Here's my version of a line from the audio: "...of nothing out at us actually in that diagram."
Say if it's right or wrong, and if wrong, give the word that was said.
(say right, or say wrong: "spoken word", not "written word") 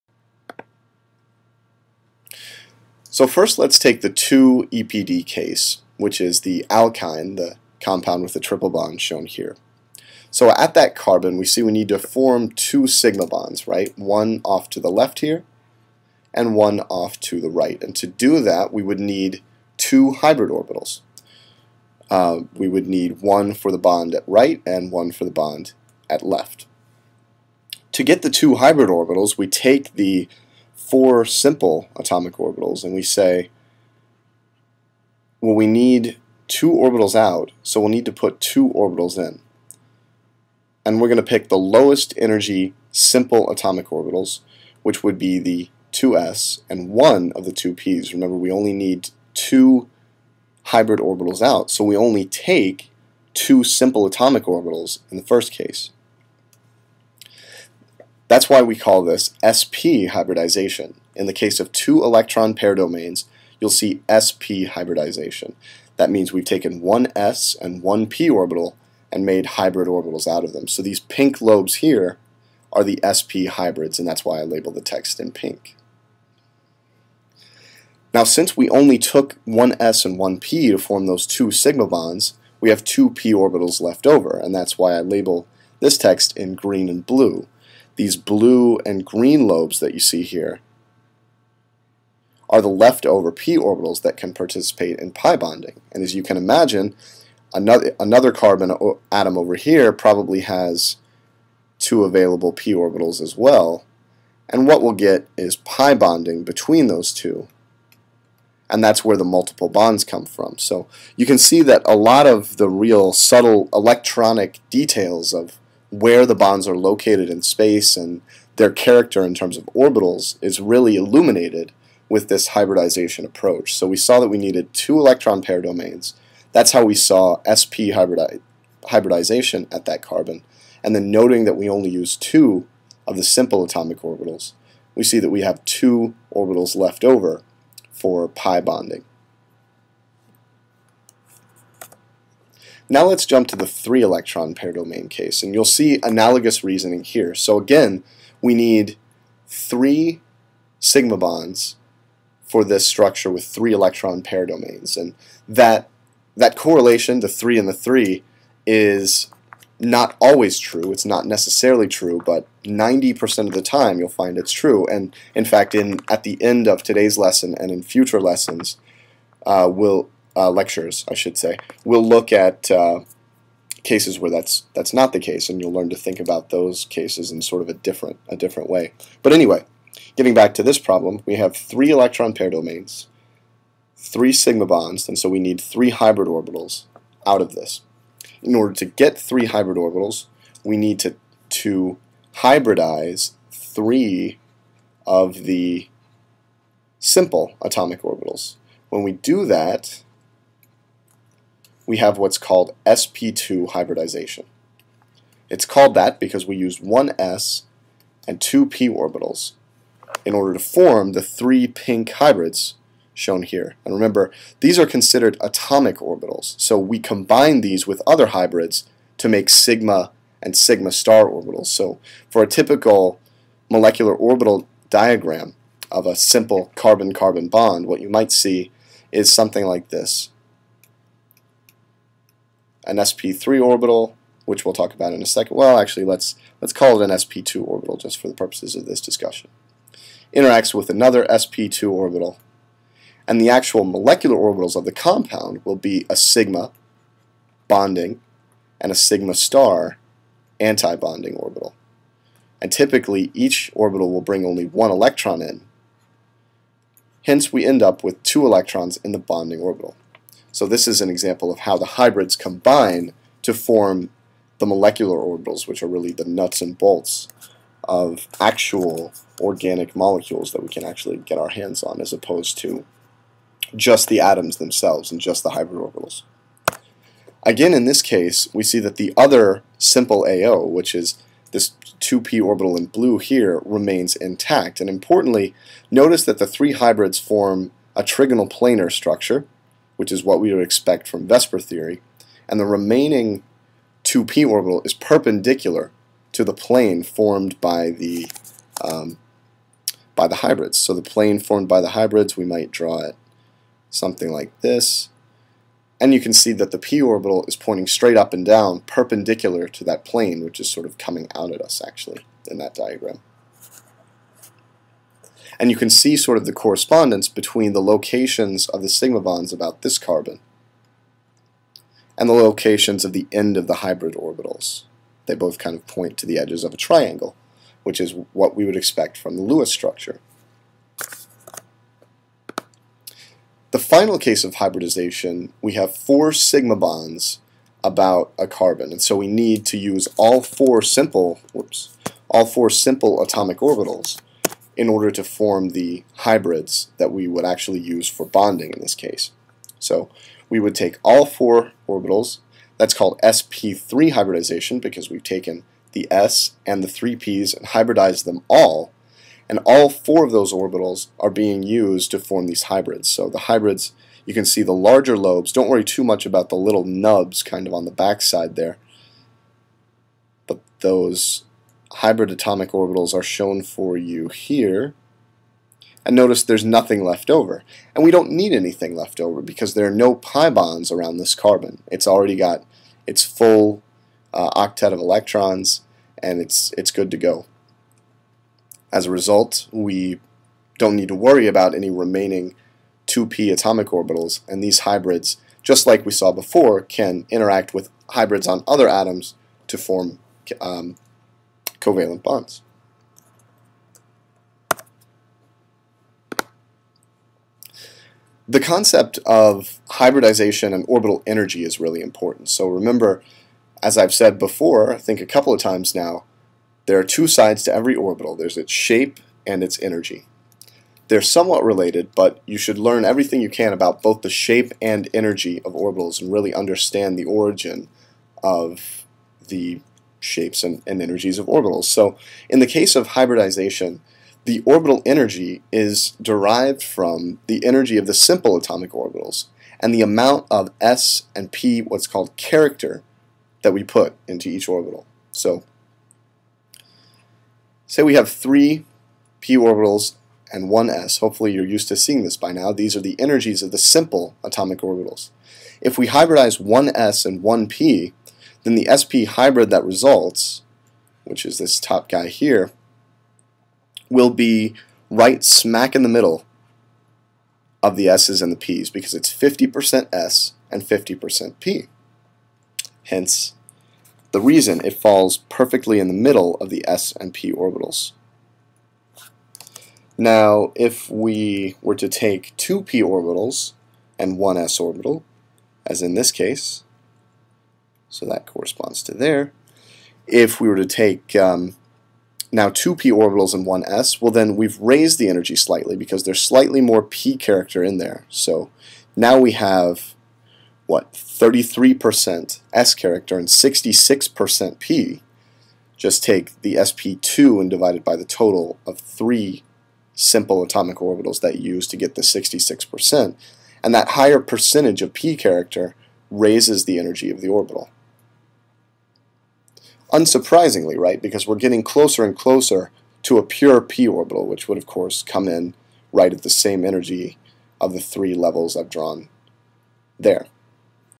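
wrong: "coming", not "nothing".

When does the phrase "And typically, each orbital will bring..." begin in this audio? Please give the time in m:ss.
4:12.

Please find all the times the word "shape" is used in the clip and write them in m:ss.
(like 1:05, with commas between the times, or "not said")
6:58, 7:04, 7:10.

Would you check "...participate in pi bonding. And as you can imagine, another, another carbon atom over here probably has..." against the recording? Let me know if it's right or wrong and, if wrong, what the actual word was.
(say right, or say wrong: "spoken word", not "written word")
right.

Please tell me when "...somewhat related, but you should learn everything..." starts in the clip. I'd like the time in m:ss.
7:01.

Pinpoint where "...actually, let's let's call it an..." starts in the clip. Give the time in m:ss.
3:55.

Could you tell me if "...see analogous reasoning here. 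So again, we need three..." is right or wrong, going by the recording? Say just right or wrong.
right.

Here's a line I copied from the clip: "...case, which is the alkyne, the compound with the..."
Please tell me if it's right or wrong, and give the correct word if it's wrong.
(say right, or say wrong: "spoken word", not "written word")
right.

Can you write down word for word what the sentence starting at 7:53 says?
Hence, the reason it falls perfectly in the middle of the S and P orbitals.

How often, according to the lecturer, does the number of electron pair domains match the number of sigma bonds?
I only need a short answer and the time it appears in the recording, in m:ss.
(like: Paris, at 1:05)
90% of the time, at 2:42.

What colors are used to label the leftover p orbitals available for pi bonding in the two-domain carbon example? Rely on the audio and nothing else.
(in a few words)
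green and blue.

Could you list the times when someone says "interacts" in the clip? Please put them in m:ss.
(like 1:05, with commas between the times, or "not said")
4:00, 6:37.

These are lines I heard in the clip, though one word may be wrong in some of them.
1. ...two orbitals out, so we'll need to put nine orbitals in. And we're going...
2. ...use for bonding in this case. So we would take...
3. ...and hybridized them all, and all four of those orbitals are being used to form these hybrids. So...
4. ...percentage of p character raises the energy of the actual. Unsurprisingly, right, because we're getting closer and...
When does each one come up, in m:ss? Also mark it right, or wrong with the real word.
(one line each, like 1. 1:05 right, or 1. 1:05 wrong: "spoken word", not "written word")
1. 0:36 wrong: "two", not "nine"
2. 5:47 right
3. 5:57 right
4. 8:34 wrong: "orbital", not "actual".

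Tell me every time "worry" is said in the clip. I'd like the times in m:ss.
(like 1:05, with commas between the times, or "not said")
6:05, 6:31.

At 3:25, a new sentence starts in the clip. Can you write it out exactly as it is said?
It's called that because we used one s and two p orbitals in order to form the three pink hybrids shown here.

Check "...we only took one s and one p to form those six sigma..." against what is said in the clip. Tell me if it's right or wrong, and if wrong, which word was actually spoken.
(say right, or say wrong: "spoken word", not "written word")
wrong: "two", not "six".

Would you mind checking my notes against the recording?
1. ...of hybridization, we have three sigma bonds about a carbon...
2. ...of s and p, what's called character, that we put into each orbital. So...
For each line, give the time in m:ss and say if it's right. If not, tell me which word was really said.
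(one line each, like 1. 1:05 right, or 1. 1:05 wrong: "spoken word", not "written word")
1. 5:34 wrong: "four", not "three"
2. 7:20 right.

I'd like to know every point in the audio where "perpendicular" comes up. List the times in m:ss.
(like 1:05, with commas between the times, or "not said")
4:54, 5:08.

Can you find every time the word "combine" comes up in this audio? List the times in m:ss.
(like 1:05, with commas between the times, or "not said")
3:36, 4:22.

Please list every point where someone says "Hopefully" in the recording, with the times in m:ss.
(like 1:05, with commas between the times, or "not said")
7:31.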